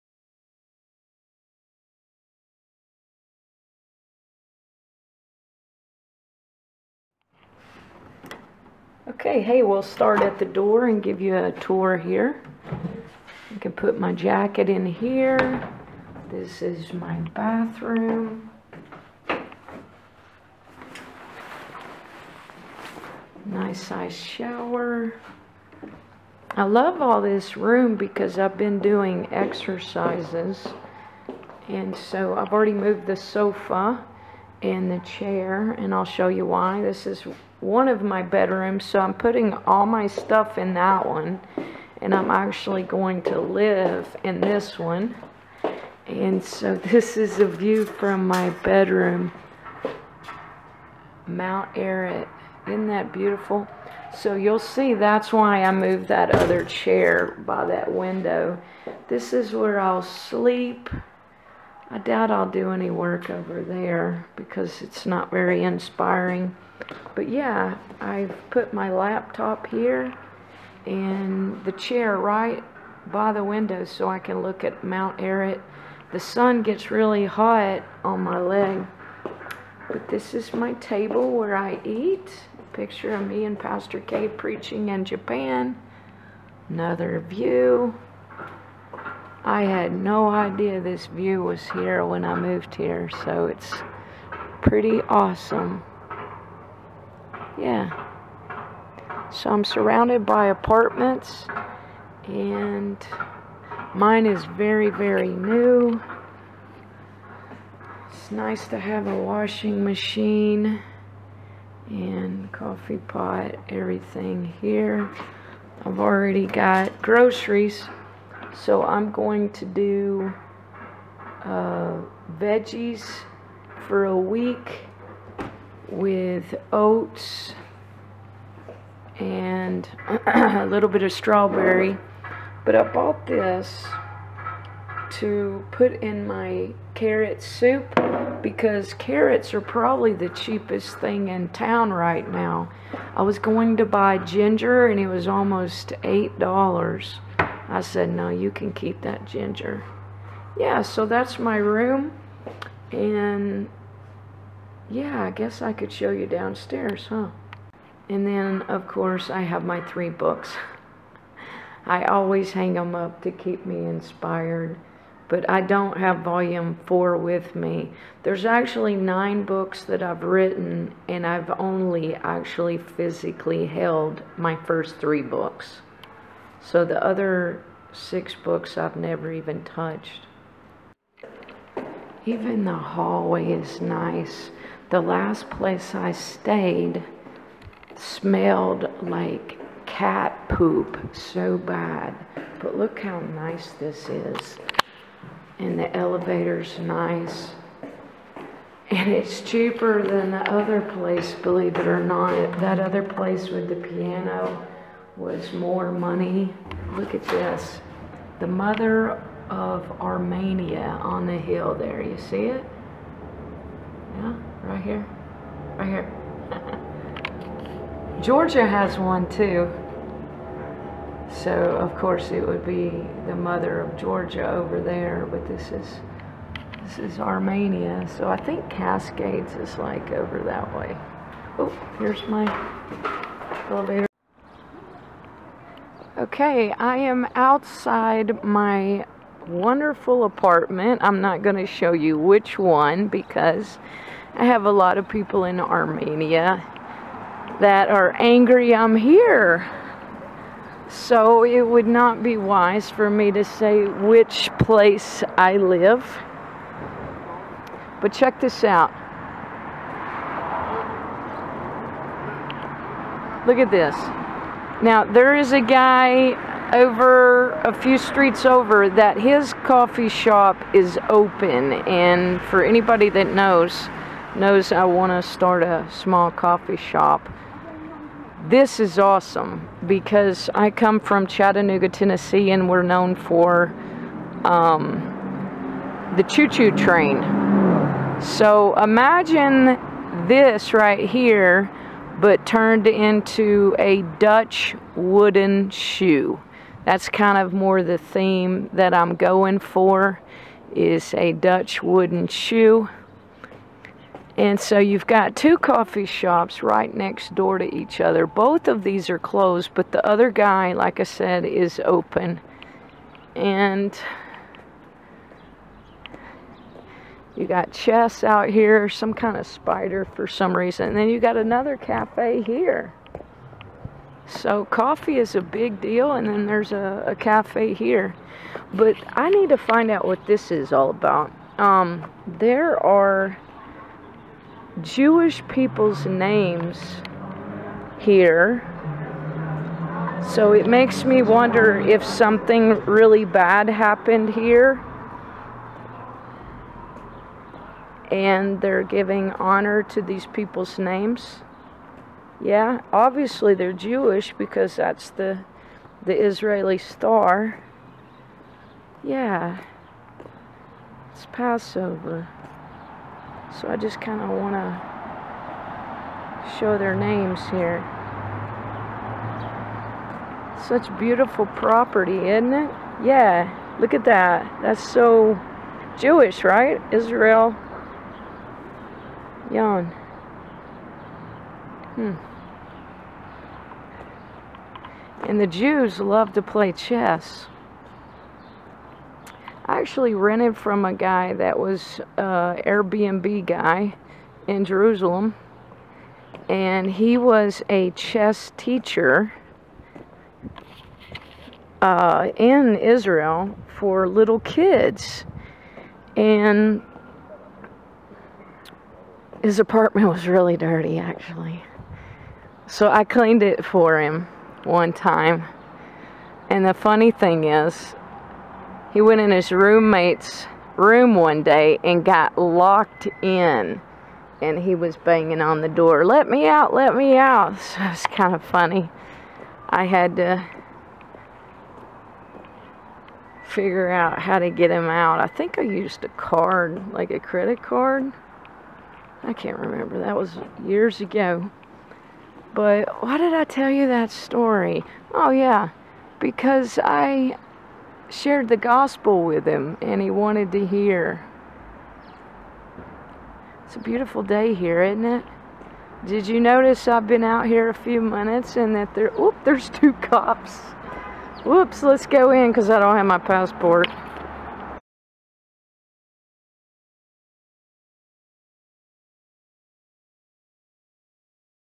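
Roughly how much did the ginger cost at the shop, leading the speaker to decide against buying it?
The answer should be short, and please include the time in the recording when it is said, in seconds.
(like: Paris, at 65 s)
$8, at 146 s.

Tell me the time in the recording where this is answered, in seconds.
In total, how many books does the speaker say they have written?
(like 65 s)
168 s.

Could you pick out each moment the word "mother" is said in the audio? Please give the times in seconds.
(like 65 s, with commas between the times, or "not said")
208 s, 223 s.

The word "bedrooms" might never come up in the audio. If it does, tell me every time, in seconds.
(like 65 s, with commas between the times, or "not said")
38 s, 48 s.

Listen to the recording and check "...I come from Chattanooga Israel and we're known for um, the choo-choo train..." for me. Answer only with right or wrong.
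wrong.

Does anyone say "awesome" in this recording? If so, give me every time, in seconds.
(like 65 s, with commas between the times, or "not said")
95 s, 278 s.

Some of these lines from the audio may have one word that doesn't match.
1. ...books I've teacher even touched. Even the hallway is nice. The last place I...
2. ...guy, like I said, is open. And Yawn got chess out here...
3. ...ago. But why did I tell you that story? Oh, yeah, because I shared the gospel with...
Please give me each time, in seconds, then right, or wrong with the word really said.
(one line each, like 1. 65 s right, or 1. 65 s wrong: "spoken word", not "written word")
1. 178 s wrong: "never", not "teacher"
2. 310 s wrong: "You", not "Yawn"
3. 441 s right.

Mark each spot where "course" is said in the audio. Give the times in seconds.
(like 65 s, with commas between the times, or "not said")
158 s, 221 s.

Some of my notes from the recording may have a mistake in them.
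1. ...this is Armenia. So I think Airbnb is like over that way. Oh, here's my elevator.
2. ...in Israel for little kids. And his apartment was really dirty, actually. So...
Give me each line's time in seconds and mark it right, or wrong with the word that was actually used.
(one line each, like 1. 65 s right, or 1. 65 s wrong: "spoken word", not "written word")
1. 226 s wrong: "Cascades", not "Airbnb"
2. 402 s right.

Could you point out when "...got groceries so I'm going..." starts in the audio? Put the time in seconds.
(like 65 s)
116 s.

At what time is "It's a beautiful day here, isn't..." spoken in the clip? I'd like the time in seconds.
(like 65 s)
453 s.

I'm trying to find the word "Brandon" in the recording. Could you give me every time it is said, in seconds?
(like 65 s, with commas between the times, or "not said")
not said.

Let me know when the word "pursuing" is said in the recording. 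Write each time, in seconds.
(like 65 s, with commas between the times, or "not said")
not said.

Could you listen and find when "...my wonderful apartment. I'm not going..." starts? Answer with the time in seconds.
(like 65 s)
238 s.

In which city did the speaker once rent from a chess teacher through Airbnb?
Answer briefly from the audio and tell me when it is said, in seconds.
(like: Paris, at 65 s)
Jerusalem, at 394 s.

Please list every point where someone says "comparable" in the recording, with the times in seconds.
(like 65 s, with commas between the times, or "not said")
not said.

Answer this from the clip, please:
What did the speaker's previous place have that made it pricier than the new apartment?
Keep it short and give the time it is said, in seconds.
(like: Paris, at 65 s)
piano, at 203 s.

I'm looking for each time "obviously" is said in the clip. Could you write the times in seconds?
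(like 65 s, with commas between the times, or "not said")
352 s.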